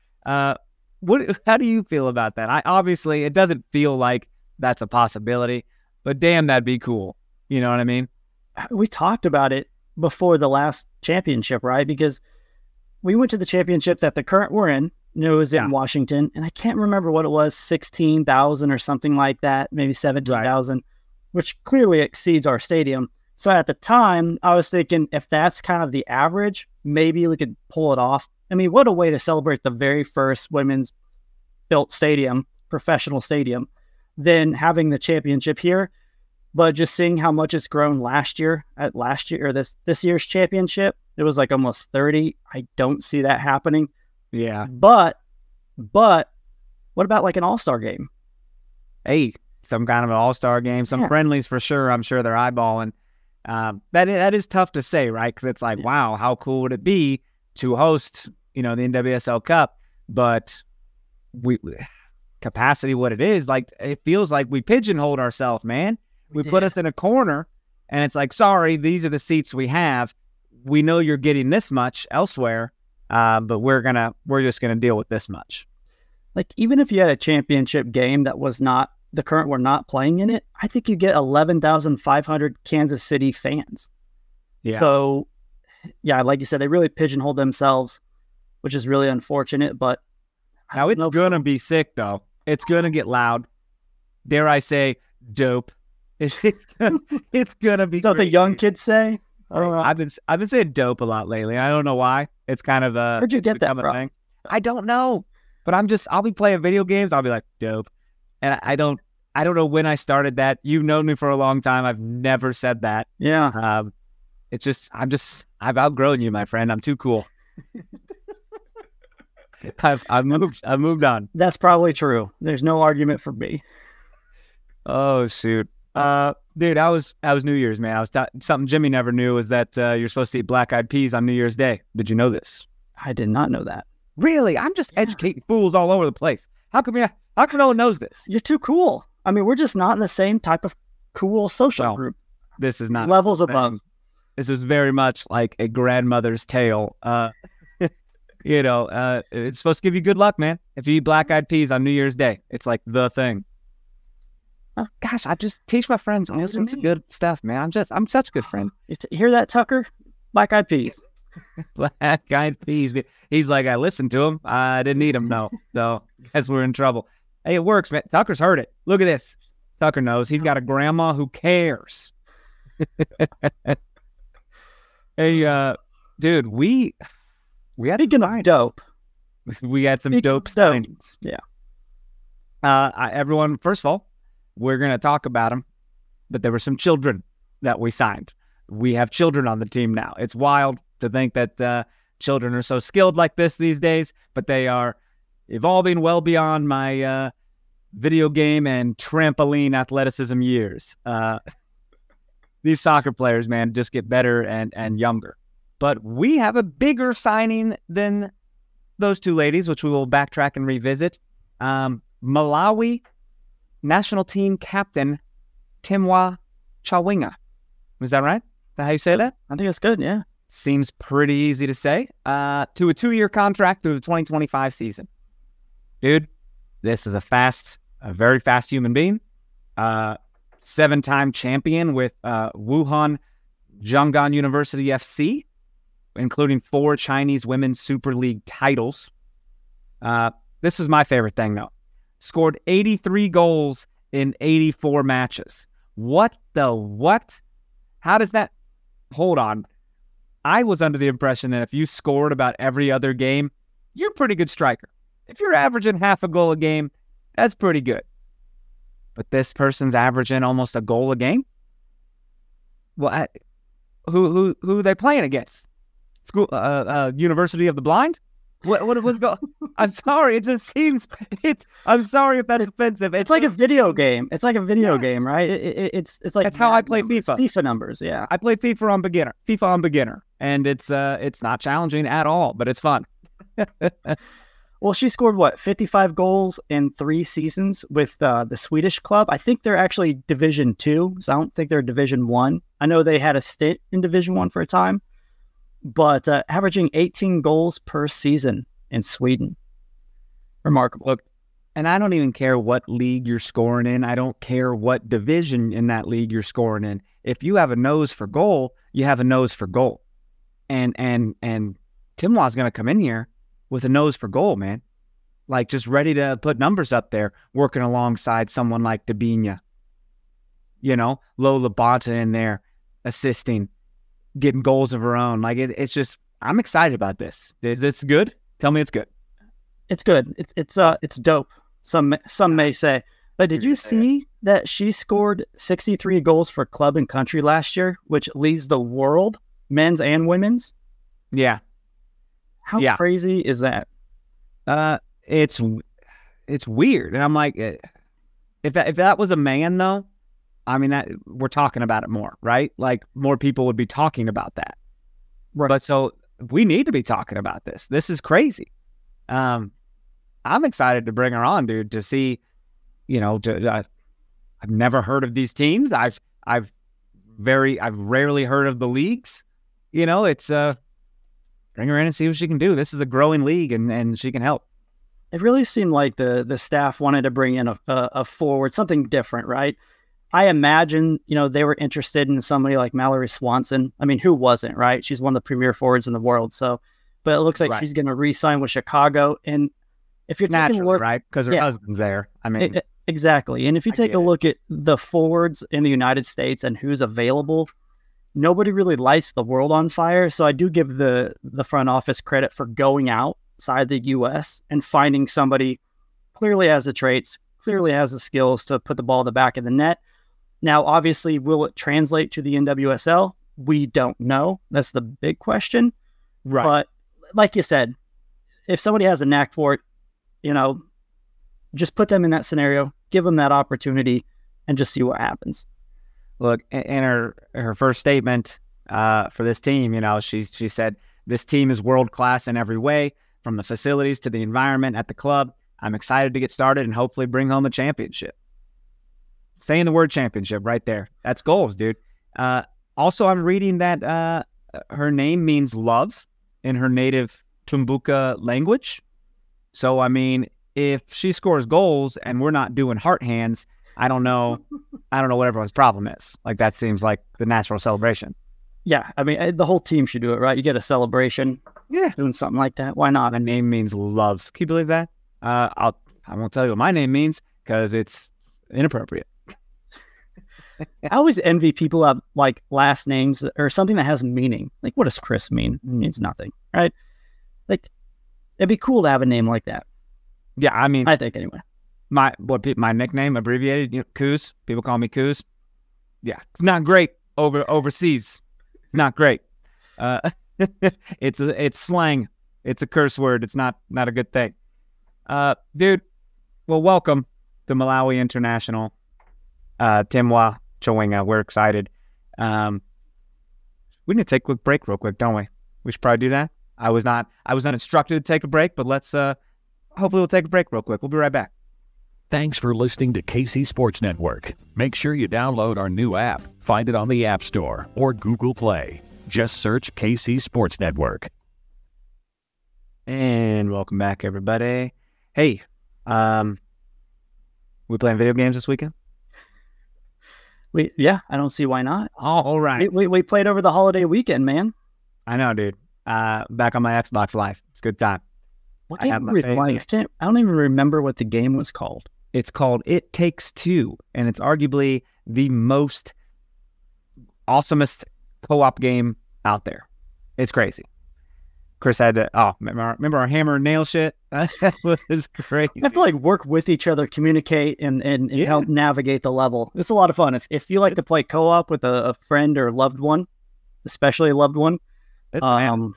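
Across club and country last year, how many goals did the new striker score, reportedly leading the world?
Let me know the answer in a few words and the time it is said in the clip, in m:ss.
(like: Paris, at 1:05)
63, at 5:35.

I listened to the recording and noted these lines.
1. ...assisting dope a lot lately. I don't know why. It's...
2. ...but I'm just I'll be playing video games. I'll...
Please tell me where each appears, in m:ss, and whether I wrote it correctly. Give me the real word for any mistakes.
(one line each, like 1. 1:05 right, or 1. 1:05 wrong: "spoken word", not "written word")
1. 1:40 wrong: "saying", not "assisting"
2. 1:45 right.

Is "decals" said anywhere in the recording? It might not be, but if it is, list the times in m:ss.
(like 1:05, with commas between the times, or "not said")
not said.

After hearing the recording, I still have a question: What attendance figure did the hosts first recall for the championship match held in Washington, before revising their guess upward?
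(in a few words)
16,000.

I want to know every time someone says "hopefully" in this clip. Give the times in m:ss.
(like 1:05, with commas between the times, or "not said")
7:16, 8:29.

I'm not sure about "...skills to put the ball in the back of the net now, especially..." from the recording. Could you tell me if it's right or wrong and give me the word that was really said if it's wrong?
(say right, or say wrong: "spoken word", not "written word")
wrong: "obviously", not "especially".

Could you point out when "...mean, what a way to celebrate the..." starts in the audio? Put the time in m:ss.
0:28.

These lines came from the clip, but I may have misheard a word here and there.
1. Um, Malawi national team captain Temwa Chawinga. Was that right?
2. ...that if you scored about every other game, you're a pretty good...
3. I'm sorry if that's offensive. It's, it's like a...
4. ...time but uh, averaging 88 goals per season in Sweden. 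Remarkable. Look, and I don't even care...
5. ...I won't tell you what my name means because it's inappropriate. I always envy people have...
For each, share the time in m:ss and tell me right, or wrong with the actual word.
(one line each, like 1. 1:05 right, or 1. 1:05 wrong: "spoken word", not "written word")
1. 3:31 right
2. 4:11 right
3. 4:31 right
4. 4:54 wrong: "18", not "88"
5. 7:46 right.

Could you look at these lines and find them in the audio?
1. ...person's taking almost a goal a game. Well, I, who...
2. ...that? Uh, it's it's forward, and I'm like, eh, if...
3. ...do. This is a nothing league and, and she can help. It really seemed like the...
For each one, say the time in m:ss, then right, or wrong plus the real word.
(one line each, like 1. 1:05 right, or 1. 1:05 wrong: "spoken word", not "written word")
1. 4:19 wrong: "averaging", not "taking"
2. 5:43 wrong: "weird", not "forward"
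3. 6:12 wrong: "growing", not "nothing".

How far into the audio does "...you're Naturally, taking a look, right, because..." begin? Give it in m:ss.
6:30.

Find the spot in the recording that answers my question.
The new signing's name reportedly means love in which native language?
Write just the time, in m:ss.
7:27.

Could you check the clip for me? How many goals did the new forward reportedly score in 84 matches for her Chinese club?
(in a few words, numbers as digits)
83.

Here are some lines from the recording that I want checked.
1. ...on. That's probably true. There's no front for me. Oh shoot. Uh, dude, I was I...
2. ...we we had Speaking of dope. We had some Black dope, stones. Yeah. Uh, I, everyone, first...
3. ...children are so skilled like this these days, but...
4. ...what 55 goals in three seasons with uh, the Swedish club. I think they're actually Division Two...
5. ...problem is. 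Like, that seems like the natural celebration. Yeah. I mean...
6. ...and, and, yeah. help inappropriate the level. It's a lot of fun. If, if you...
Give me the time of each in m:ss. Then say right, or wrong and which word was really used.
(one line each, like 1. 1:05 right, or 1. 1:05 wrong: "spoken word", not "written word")
1. 2:01 wrong: "argument", not "front"
2. 2:56 wrong: "Speaking", not "Black"
3. 3:12 right
4. 4:45 right
5. 7:35 right
6. 9:17 wrong: "navigate", not "inappropriate".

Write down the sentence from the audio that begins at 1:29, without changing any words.
But now it's gonna be sick though.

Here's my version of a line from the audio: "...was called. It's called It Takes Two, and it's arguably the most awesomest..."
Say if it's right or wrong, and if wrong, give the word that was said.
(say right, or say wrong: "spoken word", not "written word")
right.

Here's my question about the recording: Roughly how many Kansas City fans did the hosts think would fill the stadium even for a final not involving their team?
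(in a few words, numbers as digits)
11,500.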